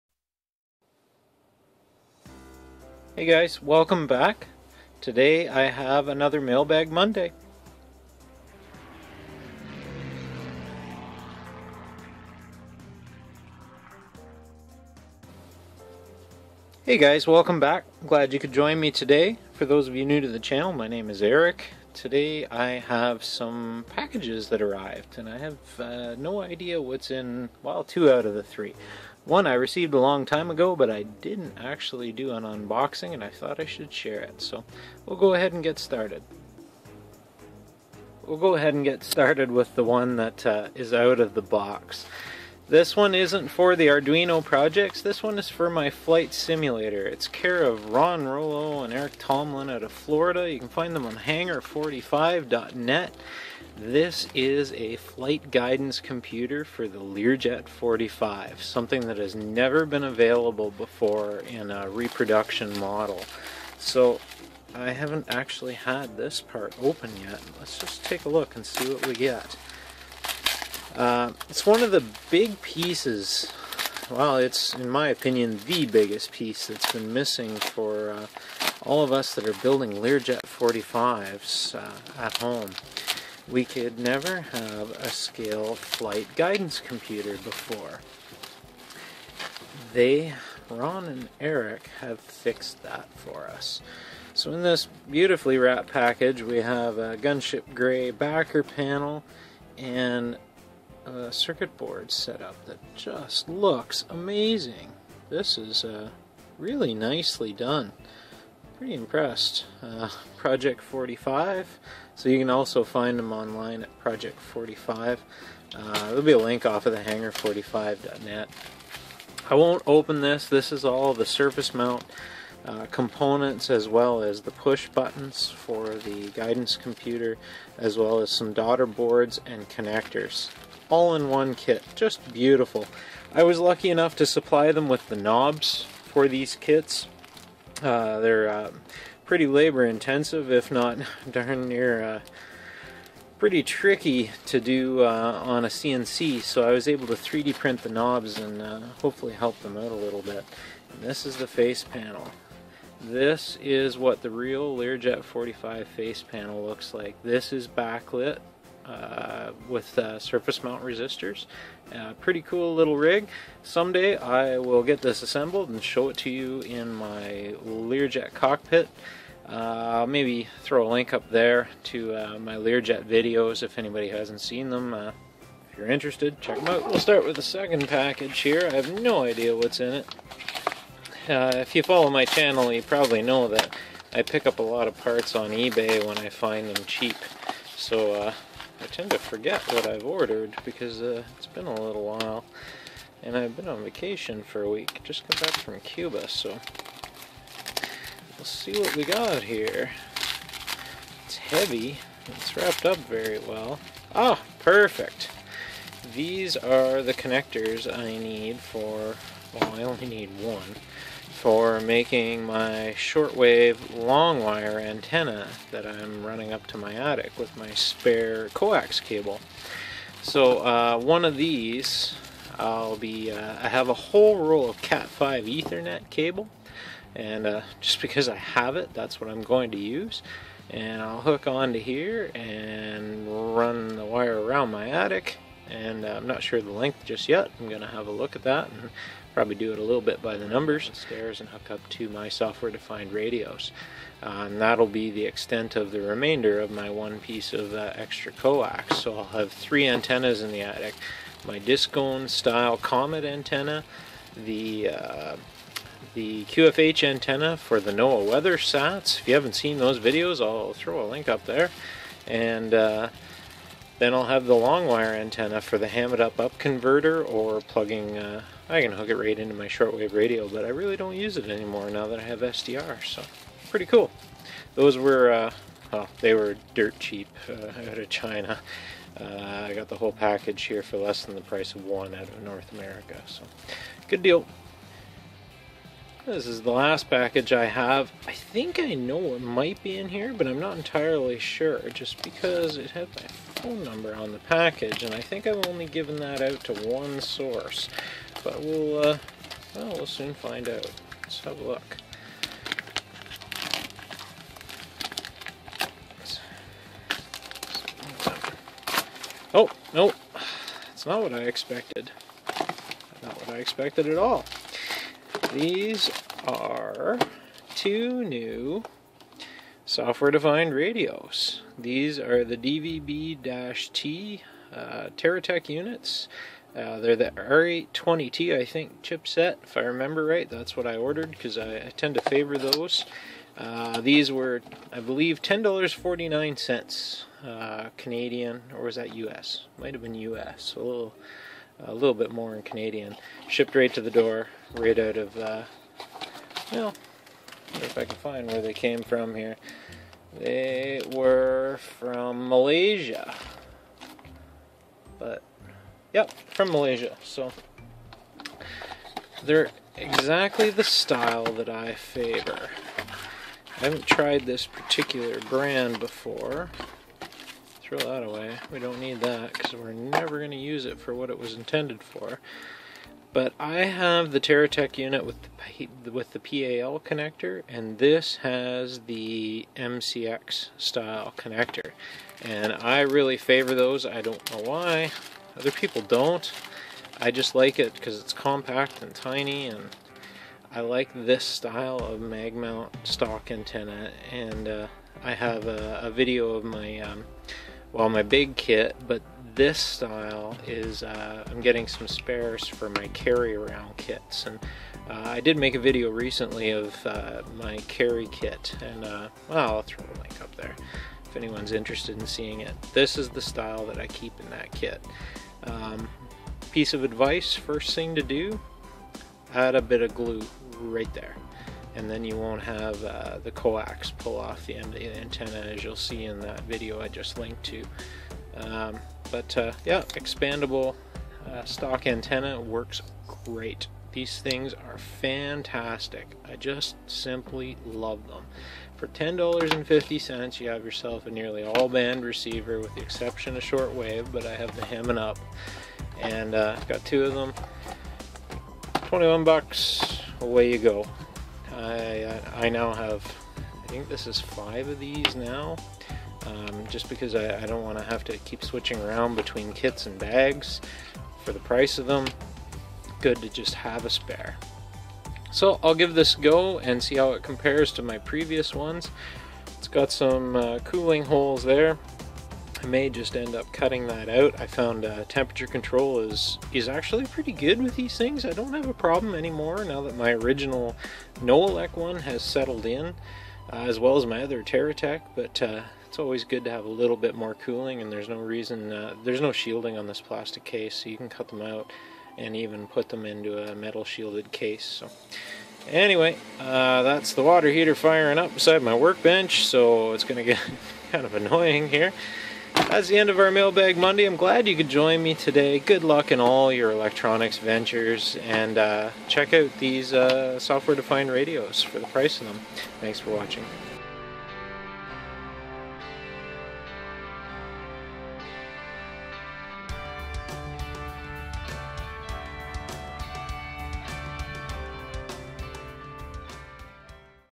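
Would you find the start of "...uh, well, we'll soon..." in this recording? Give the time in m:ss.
4:58.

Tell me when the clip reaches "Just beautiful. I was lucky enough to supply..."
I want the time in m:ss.
2:11.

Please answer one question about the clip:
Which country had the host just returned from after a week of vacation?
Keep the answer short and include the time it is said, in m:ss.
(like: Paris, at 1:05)
Cuba, at 3:15.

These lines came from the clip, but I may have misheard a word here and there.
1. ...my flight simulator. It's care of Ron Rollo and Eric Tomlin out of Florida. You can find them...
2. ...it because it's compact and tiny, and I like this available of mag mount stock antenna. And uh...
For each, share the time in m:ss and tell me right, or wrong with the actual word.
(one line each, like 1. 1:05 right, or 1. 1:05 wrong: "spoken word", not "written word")
1. 0:45 right
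2. 6:27 wrong: "style", not "available".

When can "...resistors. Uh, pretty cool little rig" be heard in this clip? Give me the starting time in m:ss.
2:40.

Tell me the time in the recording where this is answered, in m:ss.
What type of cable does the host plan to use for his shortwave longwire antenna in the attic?
3:44.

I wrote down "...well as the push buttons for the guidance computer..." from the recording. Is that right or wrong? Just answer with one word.
right.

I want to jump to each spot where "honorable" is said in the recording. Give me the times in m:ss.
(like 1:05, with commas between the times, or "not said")
not said.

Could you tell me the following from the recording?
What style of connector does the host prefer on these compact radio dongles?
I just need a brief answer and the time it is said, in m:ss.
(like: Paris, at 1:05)
MCX, at 6:19.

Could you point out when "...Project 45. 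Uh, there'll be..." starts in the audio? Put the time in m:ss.
1:53.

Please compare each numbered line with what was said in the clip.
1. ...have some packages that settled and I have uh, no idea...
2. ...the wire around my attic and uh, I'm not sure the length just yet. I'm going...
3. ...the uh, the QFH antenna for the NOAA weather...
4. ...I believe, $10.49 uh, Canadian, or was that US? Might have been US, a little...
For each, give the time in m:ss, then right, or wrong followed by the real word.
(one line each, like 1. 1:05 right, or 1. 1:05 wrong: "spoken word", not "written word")
1. 0:22 wrong: "arrived", not "settled"
2. 3:53 right
3. 4:14 right
4. 5:34 right.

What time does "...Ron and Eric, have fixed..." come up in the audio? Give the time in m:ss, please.
1:30.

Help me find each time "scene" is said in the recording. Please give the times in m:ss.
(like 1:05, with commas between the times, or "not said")
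not said.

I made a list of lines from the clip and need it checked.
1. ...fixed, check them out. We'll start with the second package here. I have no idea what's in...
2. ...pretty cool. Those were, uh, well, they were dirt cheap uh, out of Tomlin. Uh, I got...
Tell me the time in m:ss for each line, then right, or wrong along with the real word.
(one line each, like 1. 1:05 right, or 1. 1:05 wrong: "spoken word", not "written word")
1. 2:55 wrong: "interested", not "fixed"
2. 4:33 wrong: "China", not "Tomlin".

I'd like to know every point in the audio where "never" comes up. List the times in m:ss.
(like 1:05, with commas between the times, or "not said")
0:59, 1:23, 6:09.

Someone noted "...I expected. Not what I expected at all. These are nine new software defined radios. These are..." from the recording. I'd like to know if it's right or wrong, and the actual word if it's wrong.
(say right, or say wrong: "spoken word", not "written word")
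wrong: "two", not "nine".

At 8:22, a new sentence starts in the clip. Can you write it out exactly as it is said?
That's the end of our Mailbag Monday.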